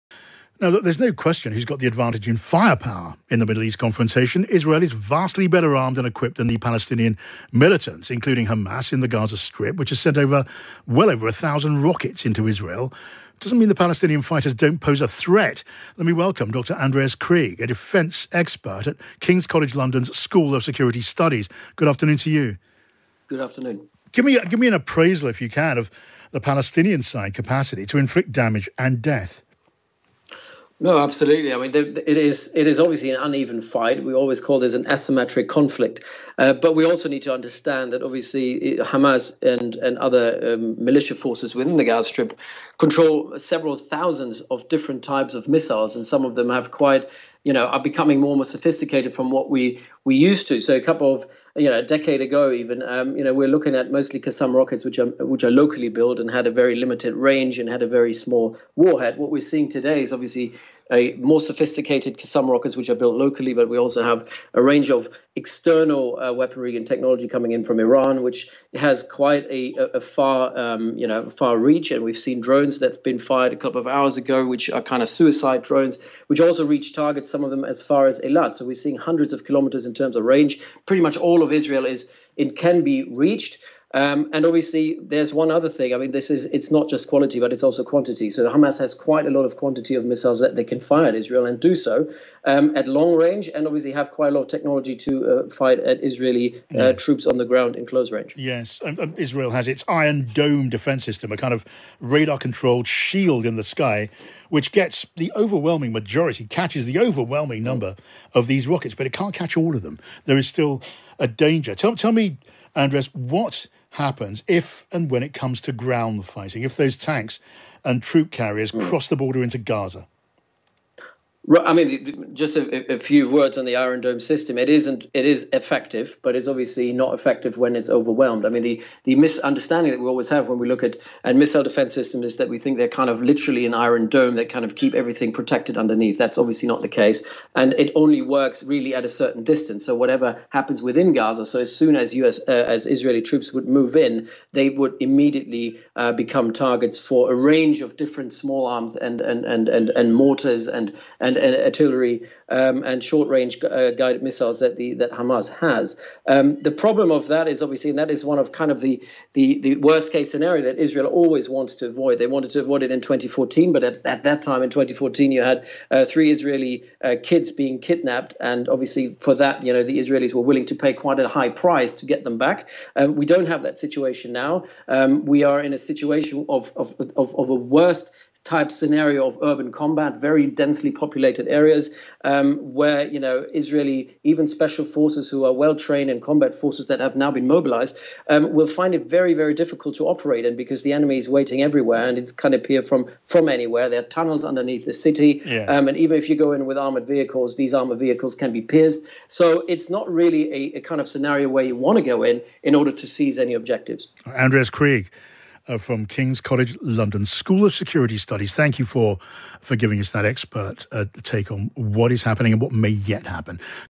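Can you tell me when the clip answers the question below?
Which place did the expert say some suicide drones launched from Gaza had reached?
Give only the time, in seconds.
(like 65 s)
78 s.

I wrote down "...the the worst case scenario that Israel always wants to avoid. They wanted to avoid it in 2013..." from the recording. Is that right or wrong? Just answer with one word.
wrong.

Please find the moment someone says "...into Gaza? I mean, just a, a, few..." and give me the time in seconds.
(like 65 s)
119 s.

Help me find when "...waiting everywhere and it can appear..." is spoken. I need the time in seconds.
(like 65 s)
191 s.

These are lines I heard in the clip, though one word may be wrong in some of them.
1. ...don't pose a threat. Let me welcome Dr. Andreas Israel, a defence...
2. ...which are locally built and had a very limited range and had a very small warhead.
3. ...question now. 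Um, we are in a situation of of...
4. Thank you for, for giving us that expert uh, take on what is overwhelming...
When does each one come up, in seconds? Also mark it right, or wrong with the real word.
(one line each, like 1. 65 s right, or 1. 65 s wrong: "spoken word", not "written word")
1. 14 s wrong: "Krieg", not "Israel"
2. 55 s right
3. 173 s wrong: "situation", not "question"
4. 208 s wrong: "happening", not "overwhelming".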